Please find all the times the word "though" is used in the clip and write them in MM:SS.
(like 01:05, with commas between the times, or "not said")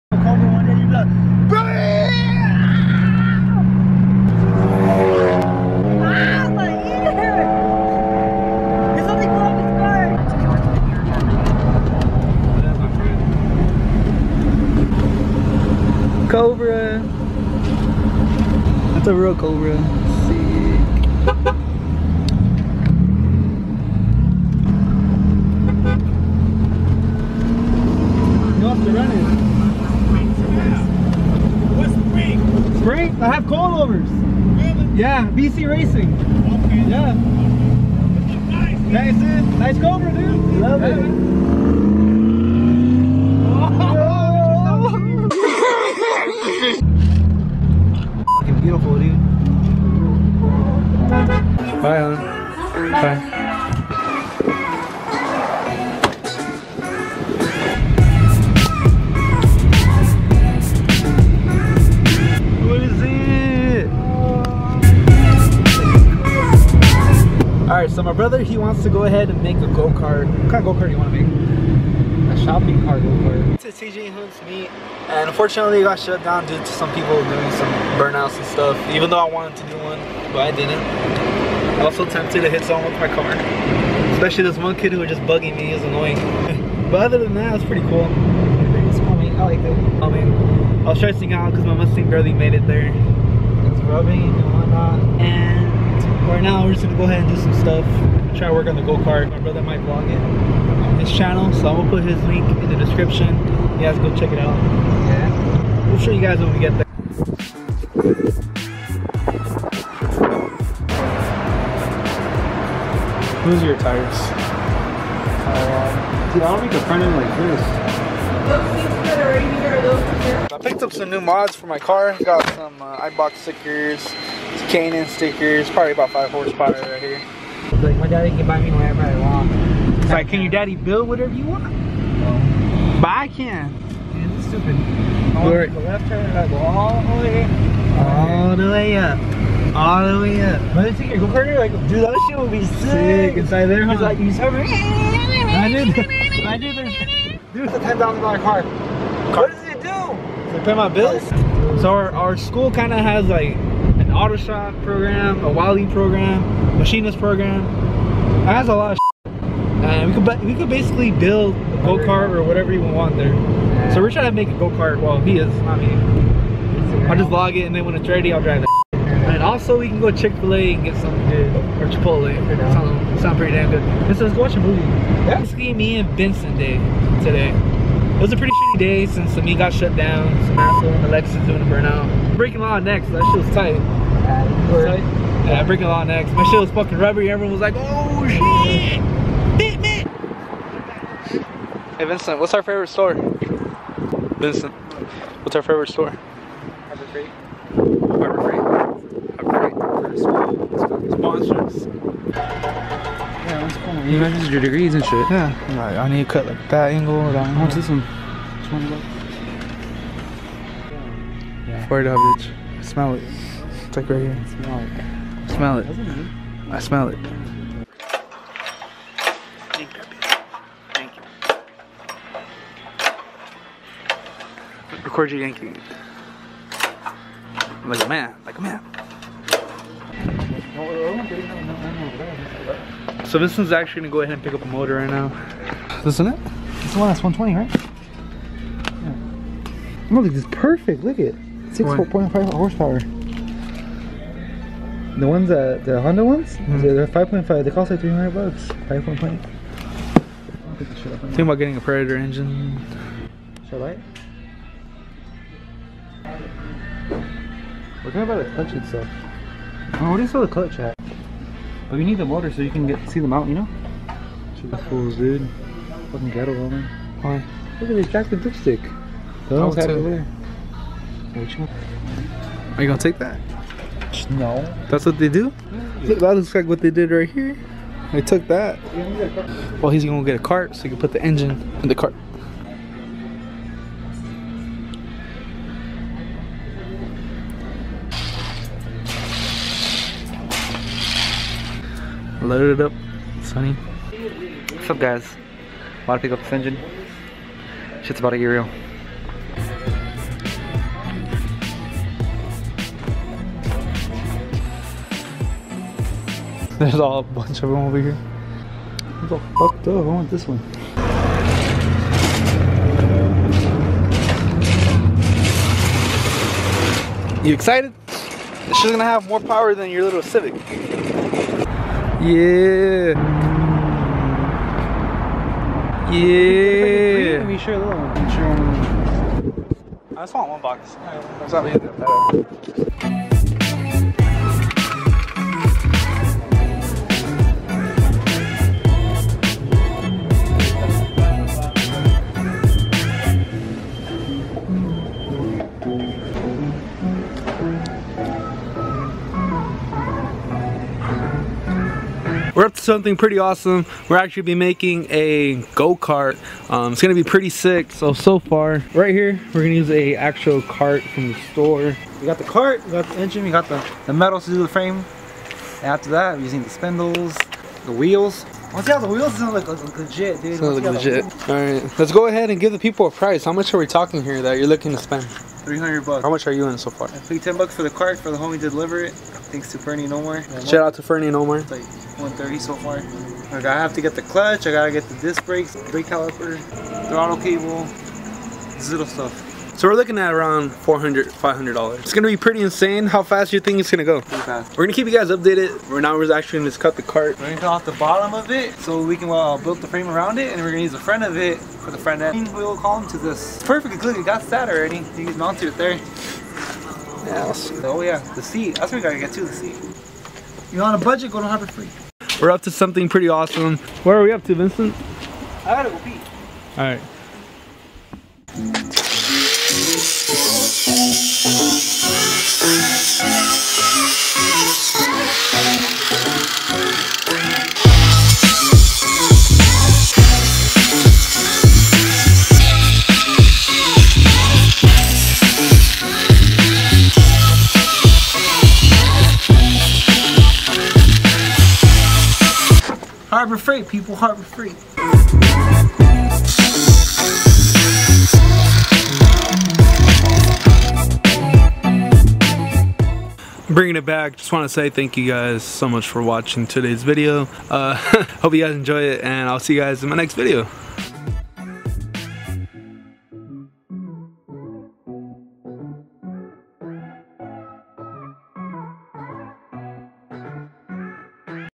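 01:19, 05:09.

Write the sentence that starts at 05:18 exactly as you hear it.
She's gonna have more power than your little Civic.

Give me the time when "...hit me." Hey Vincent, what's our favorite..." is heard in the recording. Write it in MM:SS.
03:09.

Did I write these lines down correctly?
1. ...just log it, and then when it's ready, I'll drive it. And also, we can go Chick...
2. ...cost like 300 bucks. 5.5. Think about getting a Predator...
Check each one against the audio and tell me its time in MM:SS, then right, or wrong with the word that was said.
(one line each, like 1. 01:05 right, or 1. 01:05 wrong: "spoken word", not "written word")
1. 02:47 right
2. 04:07 right.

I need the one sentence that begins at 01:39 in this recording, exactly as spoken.
My brother might vlog it on his channel, so I'm gonna put his link in the description.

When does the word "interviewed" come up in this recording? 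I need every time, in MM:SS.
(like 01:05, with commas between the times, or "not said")
not said.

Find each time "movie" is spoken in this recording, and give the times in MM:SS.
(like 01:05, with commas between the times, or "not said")
02:54.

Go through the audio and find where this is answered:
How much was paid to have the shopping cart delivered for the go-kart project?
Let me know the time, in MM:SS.
06:17.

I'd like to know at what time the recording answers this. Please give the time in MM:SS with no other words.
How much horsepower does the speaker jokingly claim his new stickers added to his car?
02:06.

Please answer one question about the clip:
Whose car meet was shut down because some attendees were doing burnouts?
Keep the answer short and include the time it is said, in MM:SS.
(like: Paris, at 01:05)
TJ Hunt, at 01:13.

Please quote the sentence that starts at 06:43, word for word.
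Perfectly good, you got that already.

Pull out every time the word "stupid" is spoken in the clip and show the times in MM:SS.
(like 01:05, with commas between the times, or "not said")
02:14.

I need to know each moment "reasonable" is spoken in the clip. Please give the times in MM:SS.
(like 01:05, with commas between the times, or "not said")
not said.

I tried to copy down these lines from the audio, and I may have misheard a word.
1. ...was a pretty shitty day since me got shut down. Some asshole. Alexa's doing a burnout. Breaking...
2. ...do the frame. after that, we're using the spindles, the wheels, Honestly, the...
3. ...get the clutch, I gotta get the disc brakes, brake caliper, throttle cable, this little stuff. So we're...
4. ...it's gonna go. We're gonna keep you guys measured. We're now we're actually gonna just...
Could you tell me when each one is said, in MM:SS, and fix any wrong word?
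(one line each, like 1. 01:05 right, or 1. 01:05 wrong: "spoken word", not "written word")
1. 02:58 right
2. 06:04 right
3. 06:24 right
4. 06:33 wrong: "updated", not "measured".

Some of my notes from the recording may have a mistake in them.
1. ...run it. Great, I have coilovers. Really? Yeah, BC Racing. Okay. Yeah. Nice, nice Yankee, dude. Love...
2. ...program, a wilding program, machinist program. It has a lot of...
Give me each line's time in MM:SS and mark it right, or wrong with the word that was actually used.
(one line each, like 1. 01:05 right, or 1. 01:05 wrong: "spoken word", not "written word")
1. 00:28 wrong: "Cobra", not "Yankee"
2. 02:34 right.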